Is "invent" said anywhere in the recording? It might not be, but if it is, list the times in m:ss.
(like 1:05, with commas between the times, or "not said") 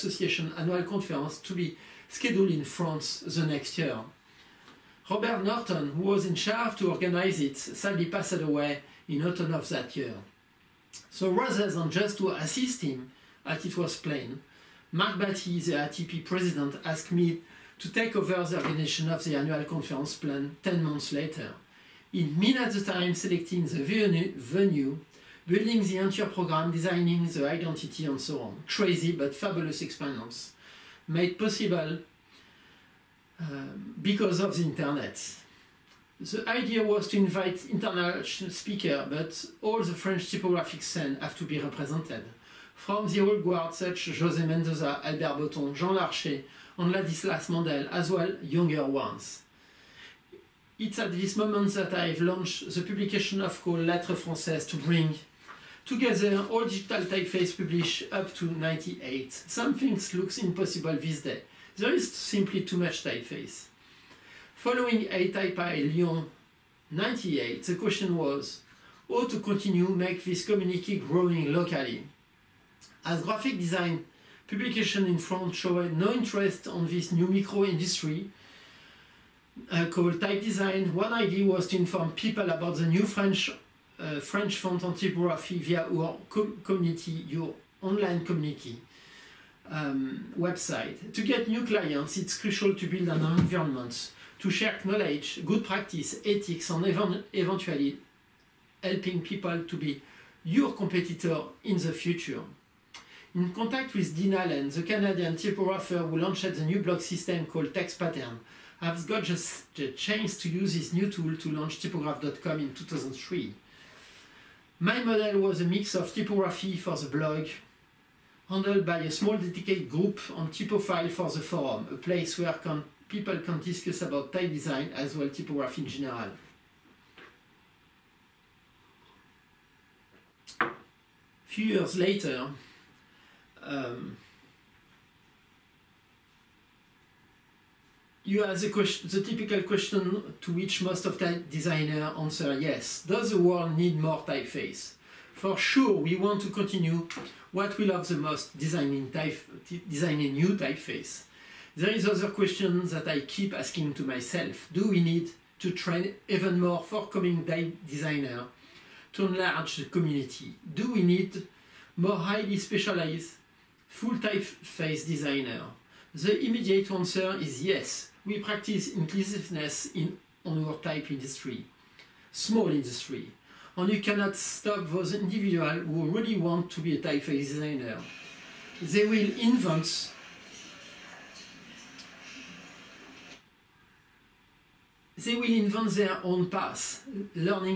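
2:59, 3:05.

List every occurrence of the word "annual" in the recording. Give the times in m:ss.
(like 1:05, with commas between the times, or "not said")
0:00, 0:19.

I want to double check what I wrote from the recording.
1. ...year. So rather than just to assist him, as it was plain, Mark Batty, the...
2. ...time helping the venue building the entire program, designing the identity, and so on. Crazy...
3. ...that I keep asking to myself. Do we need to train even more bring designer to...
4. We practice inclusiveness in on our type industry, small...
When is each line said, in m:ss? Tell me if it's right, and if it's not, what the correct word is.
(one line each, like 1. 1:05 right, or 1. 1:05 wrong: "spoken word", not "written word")
1. 0:09 right
2. 0:22 wrong: "selecting", not "helping"
3. 2:32 wrong: "forthcoming", not "bring"
4. 2:48 right.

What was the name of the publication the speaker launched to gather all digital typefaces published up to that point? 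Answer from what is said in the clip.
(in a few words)
Lettres Françaises.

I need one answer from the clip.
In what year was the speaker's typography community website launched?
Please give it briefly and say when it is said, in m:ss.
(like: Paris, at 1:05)
2003, at 1:52.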